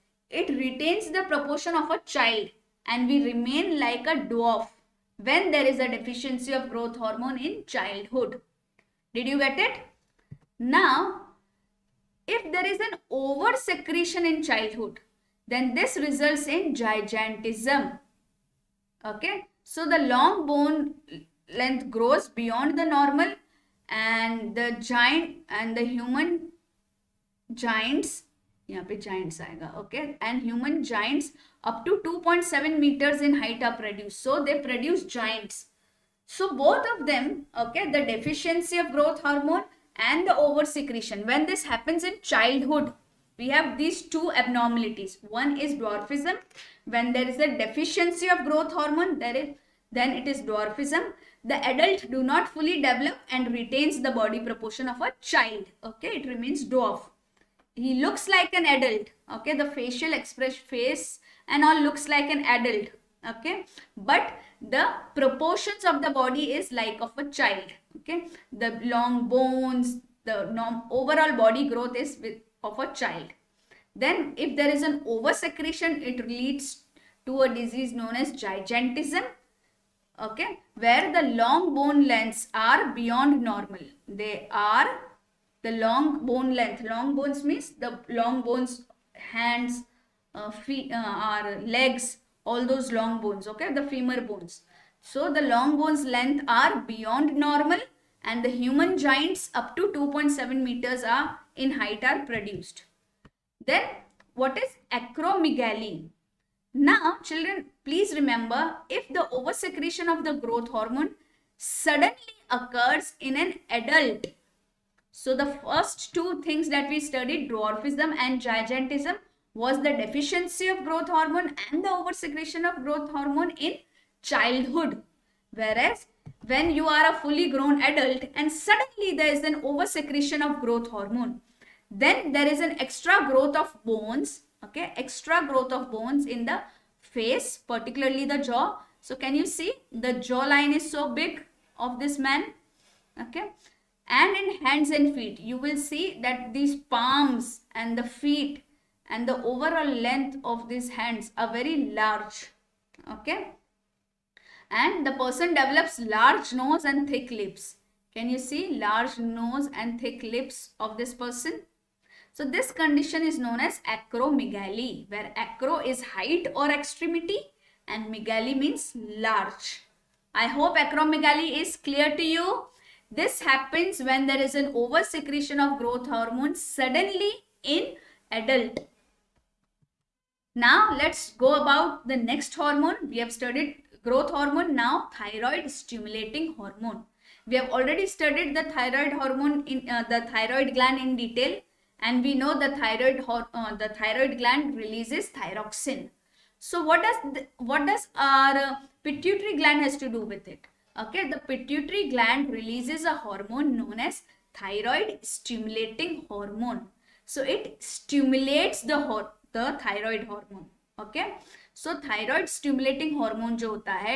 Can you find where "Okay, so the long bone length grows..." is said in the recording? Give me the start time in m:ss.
0:19.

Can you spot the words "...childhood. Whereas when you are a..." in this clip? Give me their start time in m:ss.
2:04.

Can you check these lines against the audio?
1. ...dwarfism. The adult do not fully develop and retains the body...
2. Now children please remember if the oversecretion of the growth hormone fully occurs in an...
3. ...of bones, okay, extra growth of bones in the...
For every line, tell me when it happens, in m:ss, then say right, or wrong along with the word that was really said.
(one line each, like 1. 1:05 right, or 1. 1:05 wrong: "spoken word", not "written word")
1. 0:50 right
2. 1:46 wrong: "suddenly", not "fully"
3. 2:13 right.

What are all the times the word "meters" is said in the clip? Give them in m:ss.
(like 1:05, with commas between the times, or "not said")
0:32, 1:40.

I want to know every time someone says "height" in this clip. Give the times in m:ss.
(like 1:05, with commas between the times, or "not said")
0:33, 1:41, 2:46.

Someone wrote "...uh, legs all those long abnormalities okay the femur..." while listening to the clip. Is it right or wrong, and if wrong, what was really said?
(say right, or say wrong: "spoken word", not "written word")
wrong: "bones", not "abnormalities".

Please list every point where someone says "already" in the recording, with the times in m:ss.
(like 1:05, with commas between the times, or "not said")
3:07.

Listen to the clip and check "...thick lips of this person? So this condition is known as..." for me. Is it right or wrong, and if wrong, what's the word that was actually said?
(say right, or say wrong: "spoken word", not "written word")
right.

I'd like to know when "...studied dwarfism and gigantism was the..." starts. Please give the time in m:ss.
1:56.